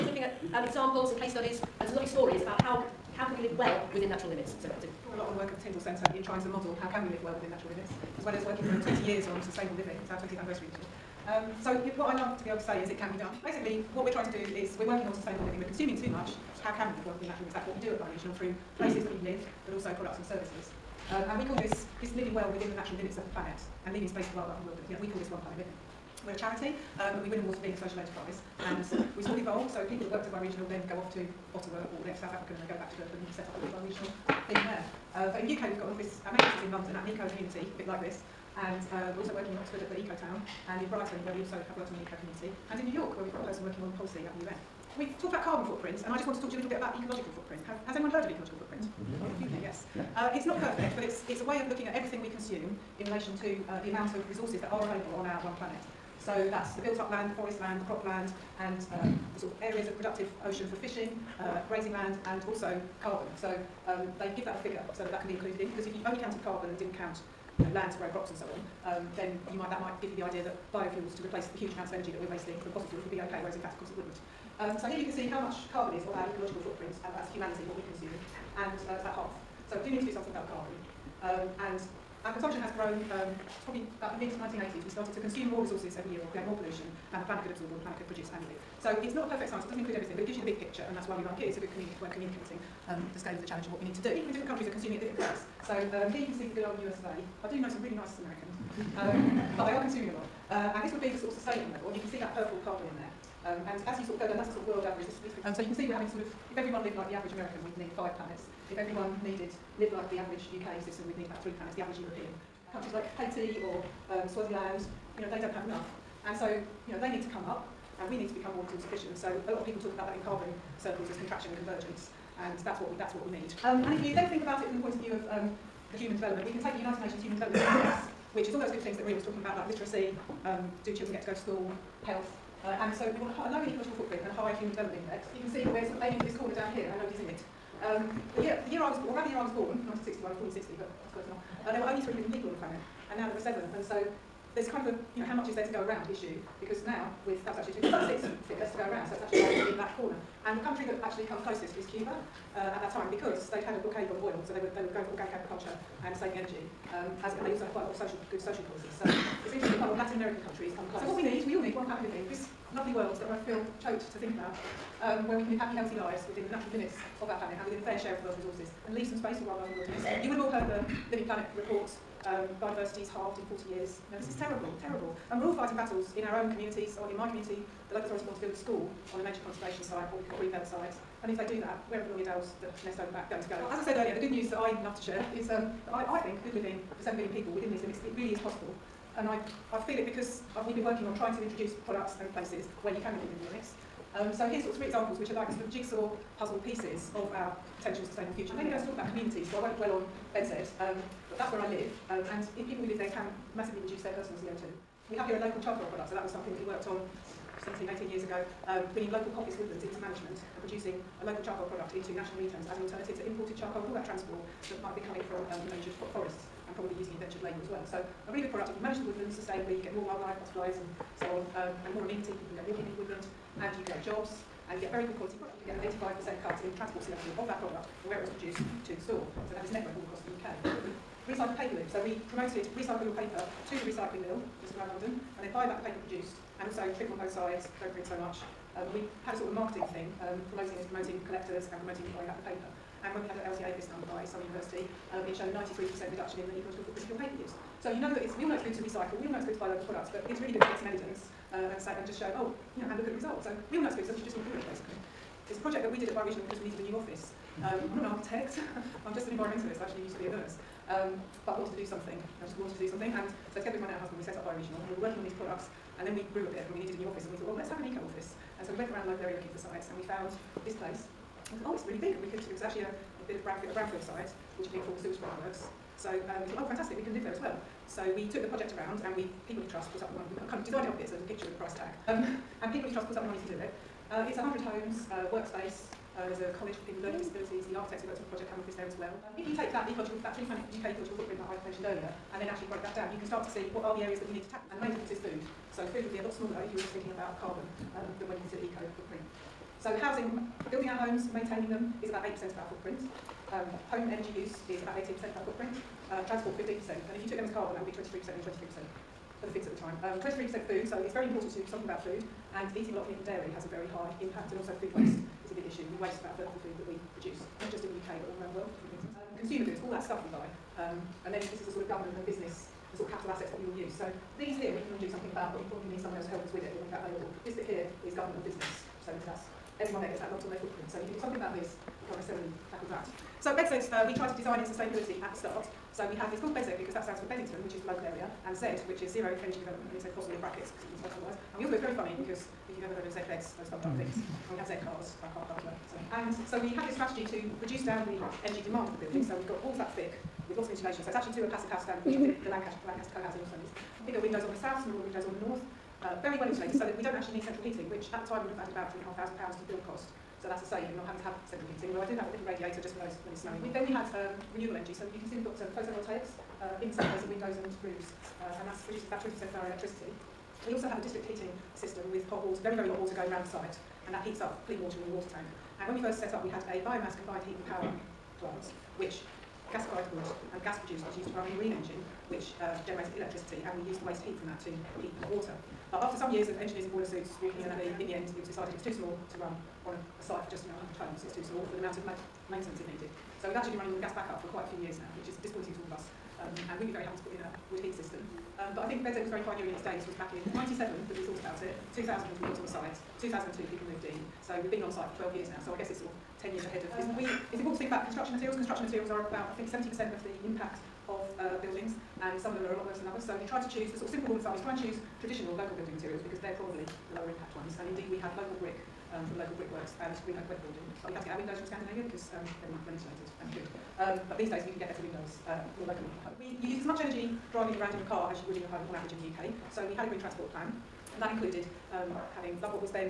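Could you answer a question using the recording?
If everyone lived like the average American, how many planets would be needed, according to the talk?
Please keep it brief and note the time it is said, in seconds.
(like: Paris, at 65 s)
5, at 107 s.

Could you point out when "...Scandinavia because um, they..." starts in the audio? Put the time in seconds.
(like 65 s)
421 s.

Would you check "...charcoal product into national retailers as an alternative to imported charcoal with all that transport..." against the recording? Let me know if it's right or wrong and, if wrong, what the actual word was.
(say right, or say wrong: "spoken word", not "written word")
right.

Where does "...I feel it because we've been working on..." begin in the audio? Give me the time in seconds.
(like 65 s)
189 s.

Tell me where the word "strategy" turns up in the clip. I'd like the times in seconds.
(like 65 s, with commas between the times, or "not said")
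346 s.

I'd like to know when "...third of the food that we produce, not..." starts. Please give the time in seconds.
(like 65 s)
316 s.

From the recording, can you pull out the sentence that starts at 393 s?
So we've actually been running on the gas backup for quite a few years now, which is disappointing to all of us.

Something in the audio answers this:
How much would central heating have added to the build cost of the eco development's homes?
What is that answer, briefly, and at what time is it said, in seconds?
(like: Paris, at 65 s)
£3,500, at 359 s.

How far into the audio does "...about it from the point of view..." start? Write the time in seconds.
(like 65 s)
124 s.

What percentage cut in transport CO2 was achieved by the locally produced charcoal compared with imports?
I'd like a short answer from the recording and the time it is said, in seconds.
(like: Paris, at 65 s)
85%, at 226 s.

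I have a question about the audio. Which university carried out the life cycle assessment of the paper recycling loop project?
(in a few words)
Surrey University.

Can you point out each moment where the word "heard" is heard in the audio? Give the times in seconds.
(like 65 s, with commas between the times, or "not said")
48 s, 170 s, 342 s.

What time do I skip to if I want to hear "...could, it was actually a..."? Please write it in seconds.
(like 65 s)
272 s.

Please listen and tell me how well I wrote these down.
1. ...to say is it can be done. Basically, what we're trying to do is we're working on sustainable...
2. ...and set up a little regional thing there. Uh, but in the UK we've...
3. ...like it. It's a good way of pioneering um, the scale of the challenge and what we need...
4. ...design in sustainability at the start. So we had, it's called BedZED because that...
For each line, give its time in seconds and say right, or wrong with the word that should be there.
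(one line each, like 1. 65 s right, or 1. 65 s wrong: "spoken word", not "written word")
1. 12 s right
2. 33 s right
3. 91 s wrong: "communicating", not "pioneering"
4. 334 s right.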